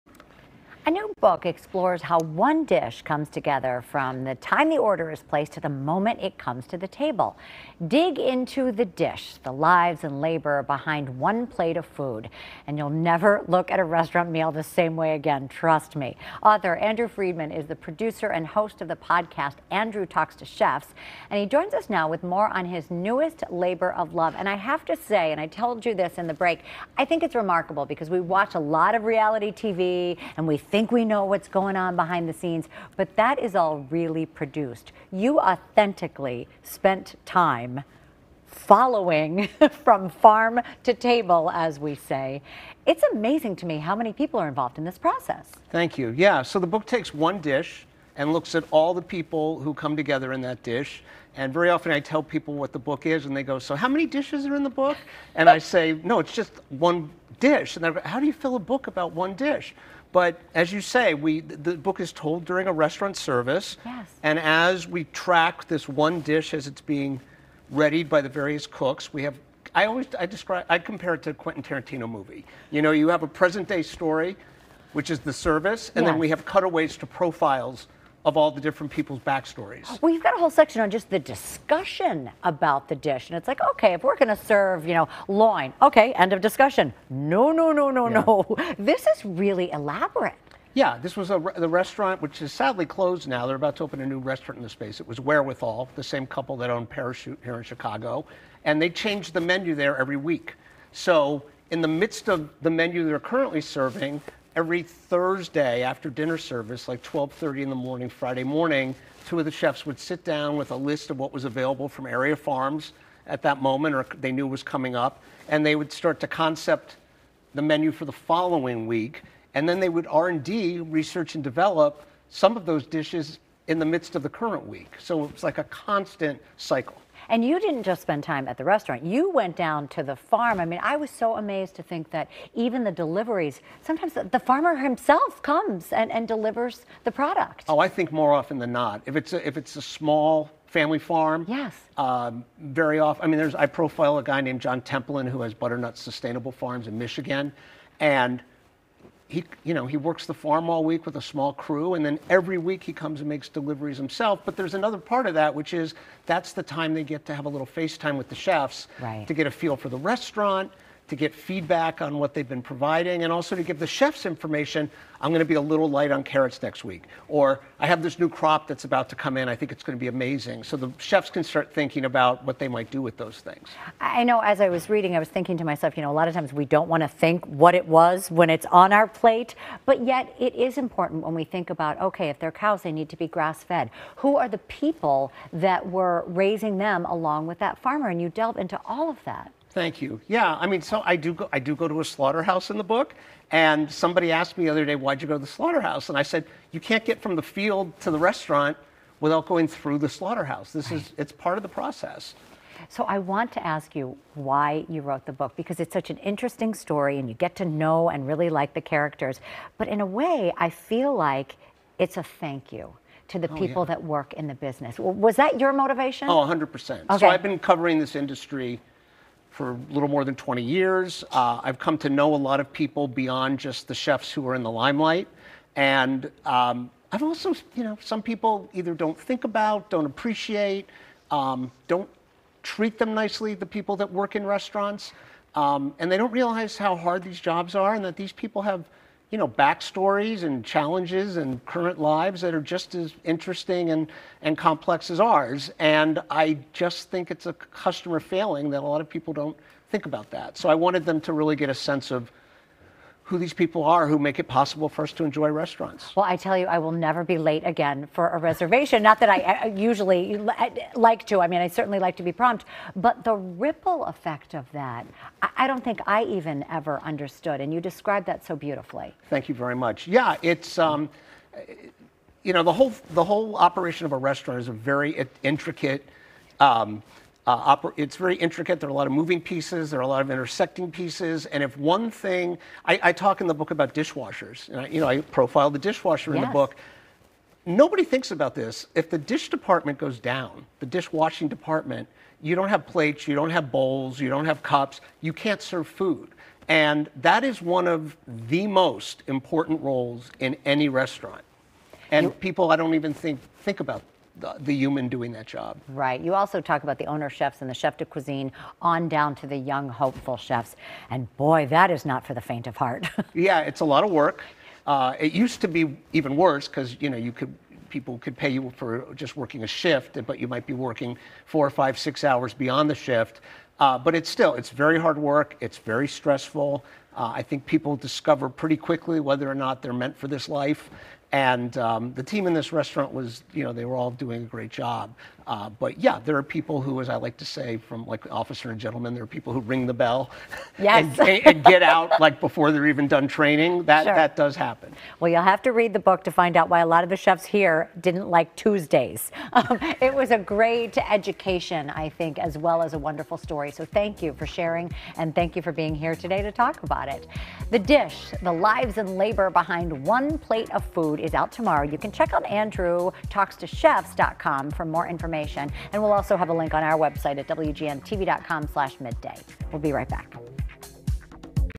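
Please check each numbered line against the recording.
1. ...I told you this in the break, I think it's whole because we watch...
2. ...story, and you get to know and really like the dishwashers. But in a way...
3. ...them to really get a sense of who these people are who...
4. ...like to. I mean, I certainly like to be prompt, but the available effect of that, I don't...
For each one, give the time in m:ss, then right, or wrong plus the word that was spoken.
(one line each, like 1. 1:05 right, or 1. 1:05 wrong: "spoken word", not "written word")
1. 0:25 wrong: "remarkable", not "whole"
2. 3:26 wrong: "characters", not "dishwashers"
3. 4:11 right
4. 4:20 wrong: "ripple", not "available".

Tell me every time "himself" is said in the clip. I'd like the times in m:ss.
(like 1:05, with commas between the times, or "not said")
2:14, 2:33.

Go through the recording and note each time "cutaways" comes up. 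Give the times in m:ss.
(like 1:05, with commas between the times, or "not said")
1:16.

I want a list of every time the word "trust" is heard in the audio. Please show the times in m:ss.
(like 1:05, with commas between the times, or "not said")
0:15.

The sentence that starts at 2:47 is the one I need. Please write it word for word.
Or I have this new crop that's about to come in.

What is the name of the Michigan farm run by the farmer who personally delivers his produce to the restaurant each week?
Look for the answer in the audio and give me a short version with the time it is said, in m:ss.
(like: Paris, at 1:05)
Butternut Sustainable Farms, at 2:25.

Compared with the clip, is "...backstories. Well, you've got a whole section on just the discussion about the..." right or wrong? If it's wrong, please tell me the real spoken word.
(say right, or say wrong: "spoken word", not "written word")
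right.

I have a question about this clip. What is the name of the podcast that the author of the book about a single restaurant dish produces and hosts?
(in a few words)
Andrew Talks to Chefs.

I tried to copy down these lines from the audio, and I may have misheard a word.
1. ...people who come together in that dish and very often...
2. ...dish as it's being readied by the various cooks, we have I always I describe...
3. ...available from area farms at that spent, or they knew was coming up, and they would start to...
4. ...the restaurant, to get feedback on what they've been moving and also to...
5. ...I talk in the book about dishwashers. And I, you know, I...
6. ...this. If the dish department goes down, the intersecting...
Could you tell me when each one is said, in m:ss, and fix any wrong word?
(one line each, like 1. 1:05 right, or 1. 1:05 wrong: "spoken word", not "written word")
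1. 0:49 right
2. 1:06 right
3. 1:51 wrong: "moment", not "spent"
4. 2:39 wrong: "providing", not "moving"
5. 4:43 right
6. 4:48 wrong: "dishwashing", not "intersecting".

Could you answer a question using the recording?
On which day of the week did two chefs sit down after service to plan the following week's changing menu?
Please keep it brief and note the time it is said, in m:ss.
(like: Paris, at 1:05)
Thursday, at 1:44.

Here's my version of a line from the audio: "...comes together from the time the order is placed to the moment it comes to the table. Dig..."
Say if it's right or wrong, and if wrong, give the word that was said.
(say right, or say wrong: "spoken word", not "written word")
right.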